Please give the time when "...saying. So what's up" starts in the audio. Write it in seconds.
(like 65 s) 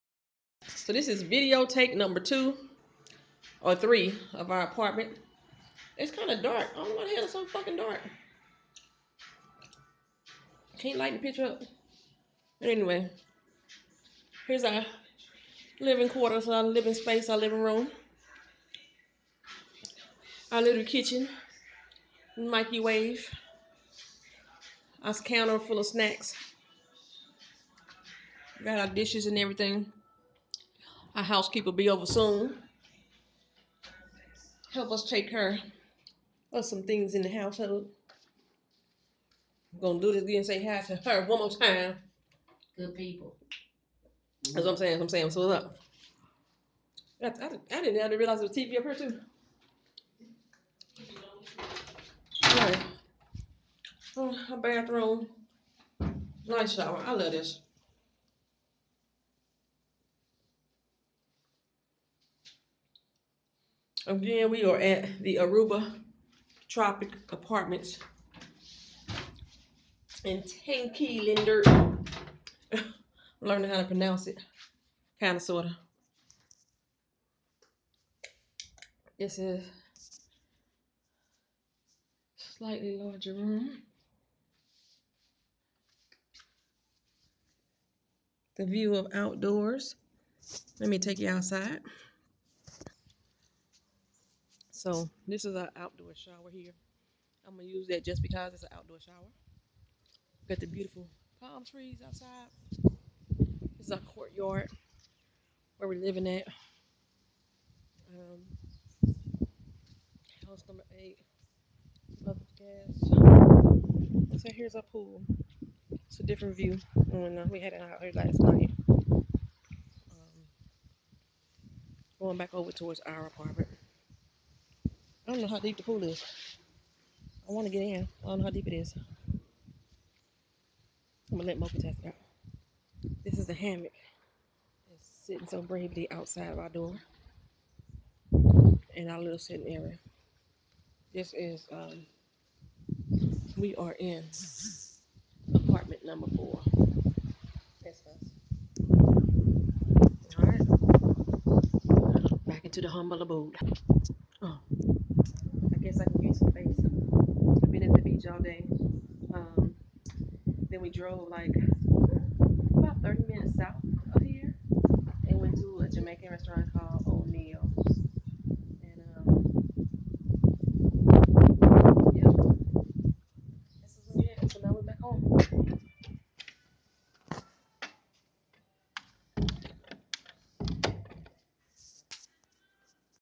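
45 s.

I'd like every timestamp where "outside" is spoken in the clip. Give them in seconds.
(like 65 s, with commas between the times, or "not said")
91 s, 102 s, 136 s.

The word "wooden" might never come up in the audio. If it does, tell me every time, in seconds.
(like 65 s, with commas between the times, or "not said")
not said.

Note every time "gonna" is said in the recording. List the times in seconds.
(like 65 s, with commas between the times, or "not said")
39 s, 97 s.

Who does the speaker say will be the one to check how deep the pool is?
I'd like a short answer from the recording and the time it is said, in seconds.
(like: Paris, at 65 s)
Mocha, at 131 s.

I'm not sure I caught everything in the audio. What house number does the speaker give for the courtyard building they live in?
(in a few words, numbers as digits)
8.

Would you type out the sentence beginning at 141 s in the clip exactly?
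This is, um, we are in apartment number four.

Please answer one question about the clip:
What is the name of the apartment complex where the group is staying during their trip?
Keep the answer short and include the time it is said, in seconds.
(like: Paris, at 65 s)
Aruba Tropic Apartments, at 65 s.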